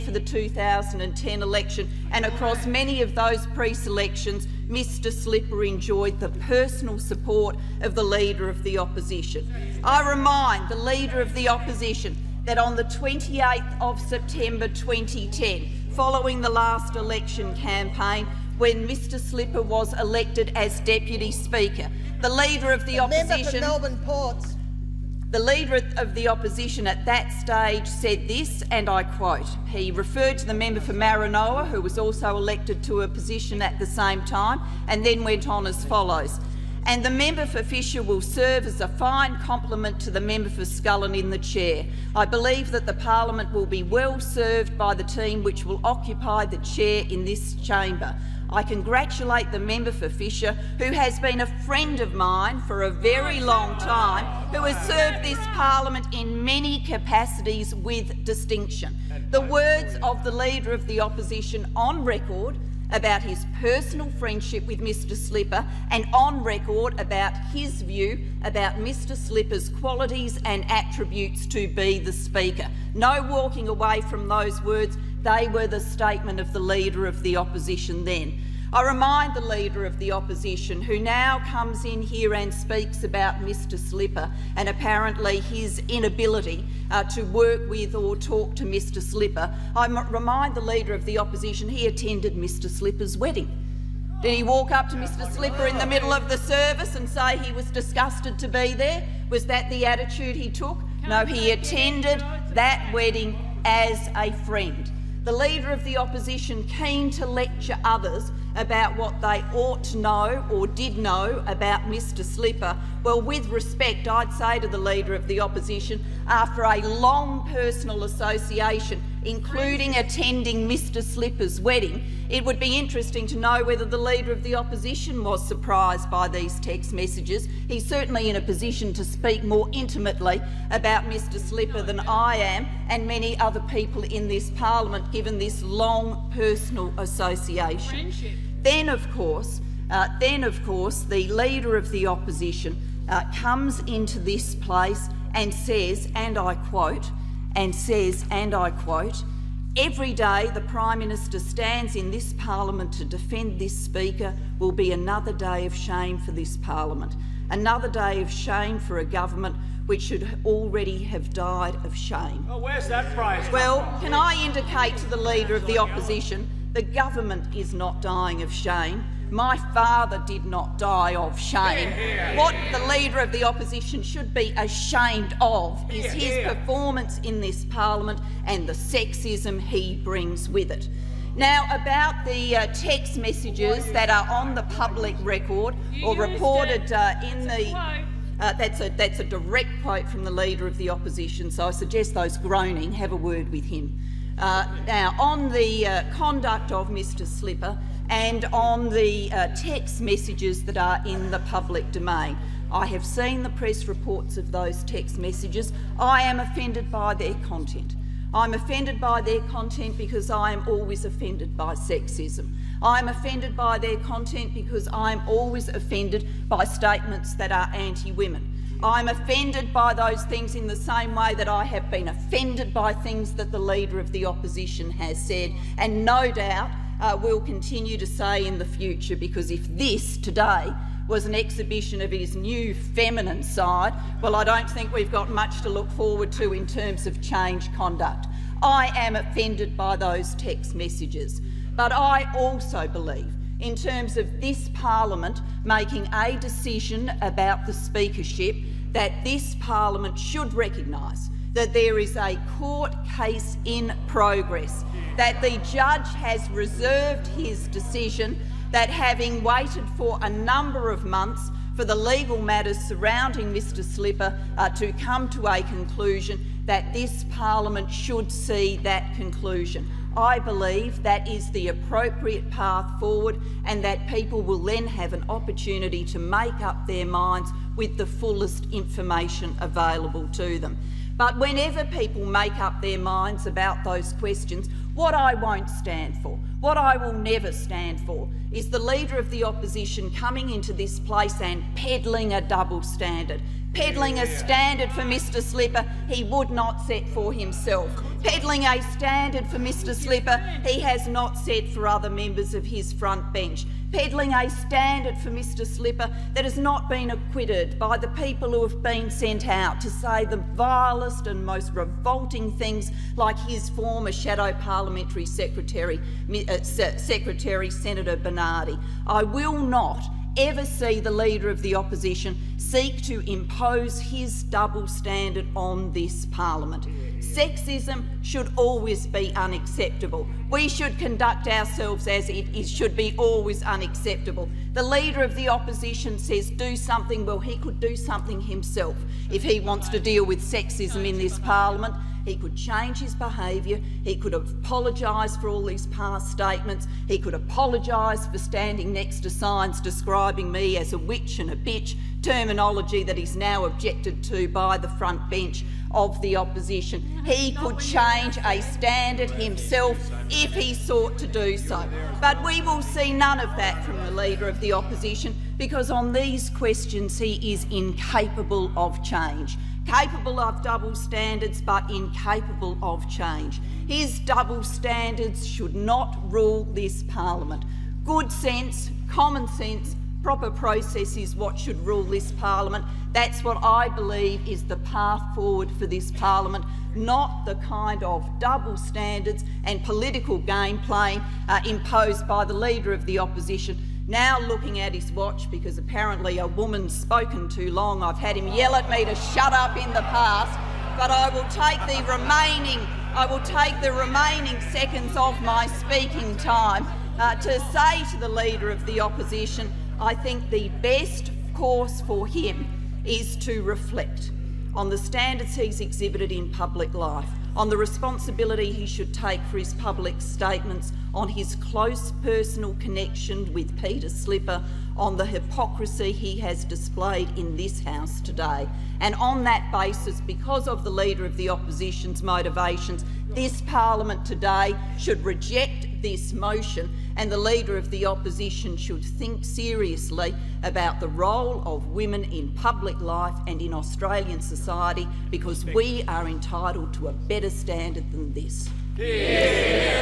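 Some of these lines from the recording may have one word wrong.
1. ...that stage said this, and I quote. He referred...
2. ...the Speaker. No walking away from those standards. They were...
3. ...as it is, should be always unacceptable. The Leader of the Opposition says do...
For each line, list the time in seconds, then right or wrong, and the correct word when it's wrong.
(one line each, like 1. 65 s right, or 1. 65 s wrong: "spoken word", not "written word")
1. 27 s right
2. 71 s wrong: "words", not "standards"
3. 332 s right.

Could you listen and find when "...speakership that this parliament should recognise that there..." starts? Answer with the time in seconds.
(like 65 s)
247 s.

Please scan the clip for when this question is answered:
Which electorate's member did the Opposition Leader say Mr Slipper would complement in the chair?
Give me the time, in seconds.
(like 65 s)
40 s.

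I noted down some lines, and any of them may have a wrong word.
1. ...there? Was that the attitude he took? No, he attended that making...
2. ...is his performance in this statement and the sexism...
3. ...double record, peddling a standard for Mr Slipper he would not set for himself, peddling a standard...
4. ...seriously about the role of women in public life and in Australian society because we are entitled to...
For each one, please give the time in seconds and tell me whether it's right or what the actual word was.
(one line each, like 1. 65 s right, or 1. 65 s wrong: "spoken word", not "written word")
1. 98 s wrong: "wedding", not "making"
2. 175 s wrong: "parliament", not "statement"
3. 292 s wrong: "standard", not "record"
4. 439 s right.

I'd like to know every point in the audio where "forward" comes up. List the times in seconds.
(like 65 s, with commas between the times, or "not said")
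235 s, 272 s, 385 s.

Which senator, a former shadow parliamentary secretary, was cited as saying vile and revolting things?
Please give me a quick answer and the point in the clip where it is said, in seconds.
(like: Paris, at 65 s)
Senator Bernardi, at 317 s.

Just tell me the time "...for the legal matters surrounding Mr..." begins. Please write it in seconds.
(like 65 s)
261 s.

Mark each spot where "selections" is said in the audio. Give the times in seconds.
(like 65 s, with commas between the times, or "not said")
3 s.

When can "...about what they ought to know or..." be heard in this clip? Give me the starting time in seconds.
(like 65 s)
108 s.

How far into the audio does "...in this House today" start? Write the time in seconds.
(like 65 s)
427 s.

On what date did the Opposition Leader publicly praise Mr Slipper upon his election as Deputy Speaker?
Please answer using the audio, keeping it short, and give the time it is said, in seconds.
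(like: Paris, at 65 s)
28 September 2010, at 12 s.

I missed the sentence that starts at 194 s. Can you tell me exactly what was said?
Uh, now, on the uh, conduct of Mr Slipper and on the uh, text messages that are in the public domain.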